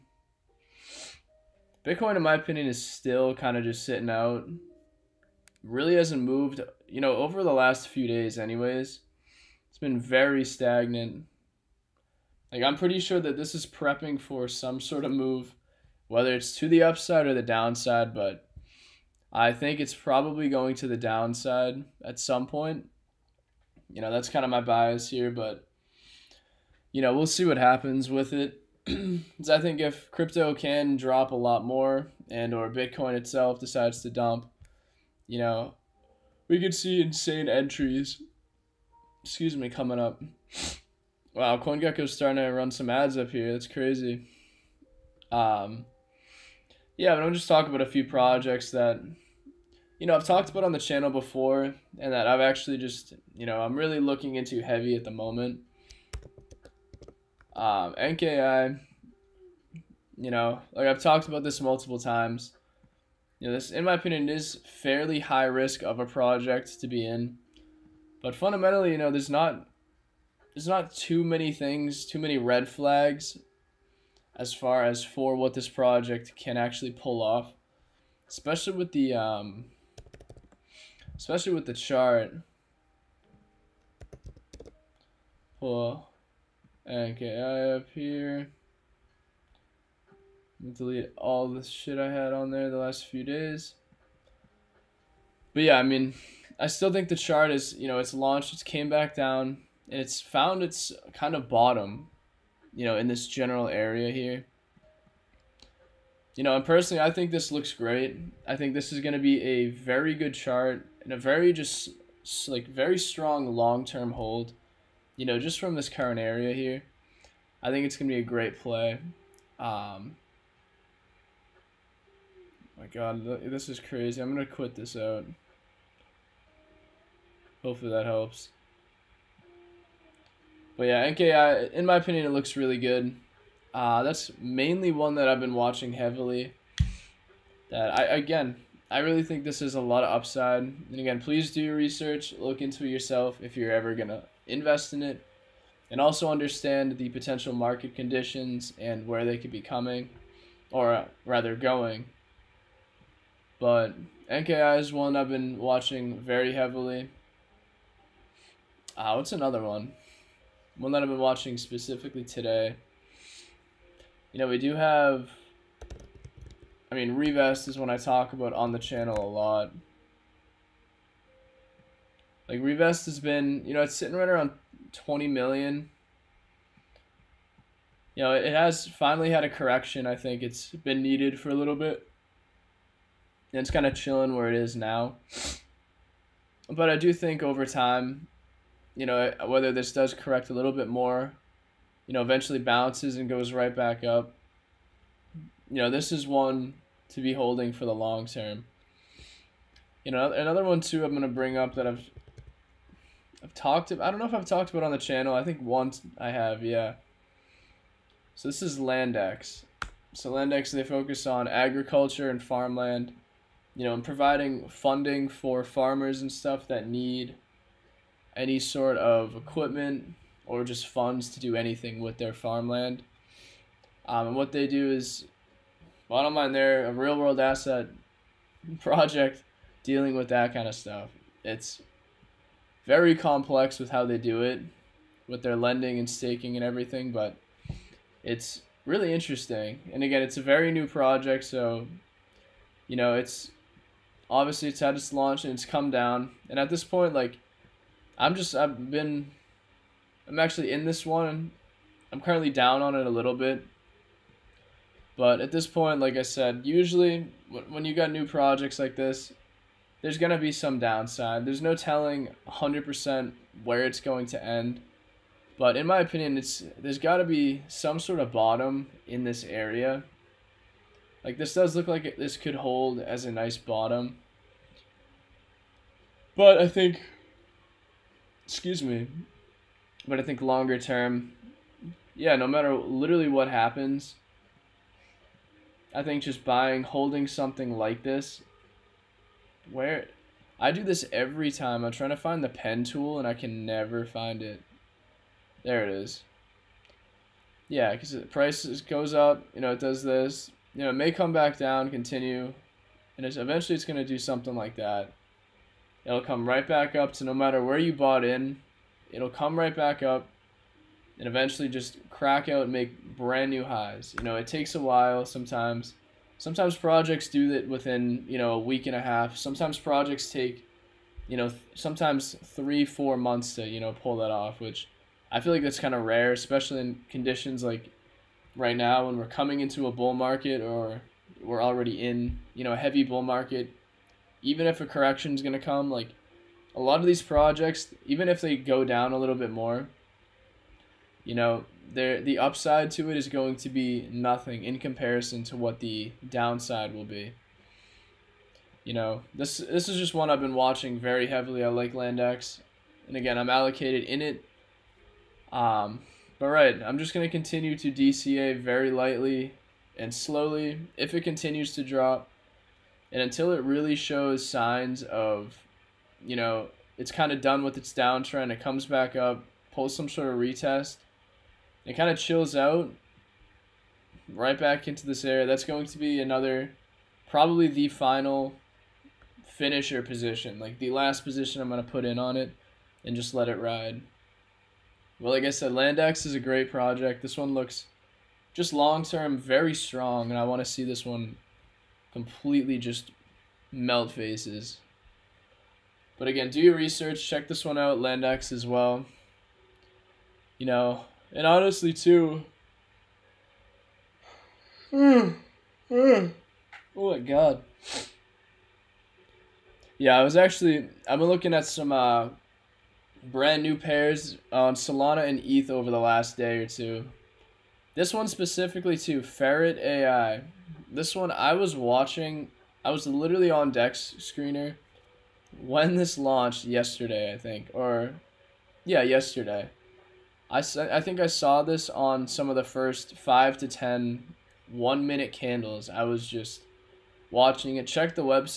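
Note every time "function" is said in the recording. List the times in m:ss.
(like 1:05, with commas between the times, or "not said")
not said.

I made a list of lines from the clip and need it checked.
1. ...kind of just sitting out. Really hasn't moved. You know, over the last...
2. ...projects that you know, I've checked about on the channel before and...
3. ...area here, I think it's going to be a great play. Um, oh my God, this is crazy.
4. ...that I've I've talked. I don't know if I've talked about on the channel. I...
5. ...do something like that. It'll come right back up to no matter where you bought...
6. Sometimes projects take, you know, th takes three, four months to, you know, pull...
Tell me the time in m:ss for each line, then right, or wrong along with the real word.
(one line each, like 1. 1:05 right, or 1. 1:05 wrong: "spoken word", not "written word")
1. 0:03 right
2. 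0:48 wrong: "talked", not "checked"
3. 1:56 right
4. 3:21 right
5. 5:04 right
6. 5:19 wrong: "sometimes", not "takes".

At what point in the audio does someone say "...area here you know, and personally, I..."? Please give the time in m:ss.
1:43.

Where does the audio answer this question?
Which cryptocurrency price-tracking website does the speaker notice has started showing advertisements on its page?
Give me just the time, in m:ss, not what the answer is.
0:41.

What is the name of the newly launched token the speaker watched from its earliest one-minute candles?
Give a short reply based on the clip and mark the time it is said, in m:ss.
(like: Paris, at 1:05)
Ferret AI, at 6:59.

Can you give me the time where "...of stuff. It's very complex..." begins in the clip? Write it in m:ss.
3:50.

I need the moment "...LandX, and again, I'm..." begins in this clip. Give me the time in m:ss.
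5:51.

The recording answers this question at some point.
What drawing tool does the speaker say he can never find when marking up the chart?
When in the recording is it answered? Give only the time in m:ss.
4:52.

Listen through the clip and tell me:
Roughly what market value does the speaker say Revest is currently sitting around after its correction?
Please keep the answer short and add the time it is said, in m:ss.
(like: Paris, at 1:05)
20 million, at 2:54.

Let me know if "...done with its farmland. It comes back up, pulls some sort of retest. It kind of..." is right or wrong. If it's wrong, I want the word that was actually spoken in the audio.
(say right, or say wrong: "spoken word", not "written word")
wrong: "downtrend", not "farmland".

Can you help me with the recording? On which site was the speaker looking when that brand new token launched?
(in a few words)
Dex Screener.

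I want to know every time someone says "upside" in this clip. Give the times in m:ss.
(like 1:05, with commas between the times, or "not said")
0:16, 2:20, 5:42.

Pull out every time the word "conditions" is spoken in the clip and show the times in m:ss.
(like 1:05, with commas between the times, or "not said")
2:27, 5:27.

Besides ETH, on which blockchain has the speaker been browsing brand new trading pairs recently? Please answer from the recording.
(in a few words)
Solana.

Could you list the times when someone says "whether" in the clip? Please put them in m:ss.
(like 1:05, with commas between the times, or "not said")
0:16, 3:09.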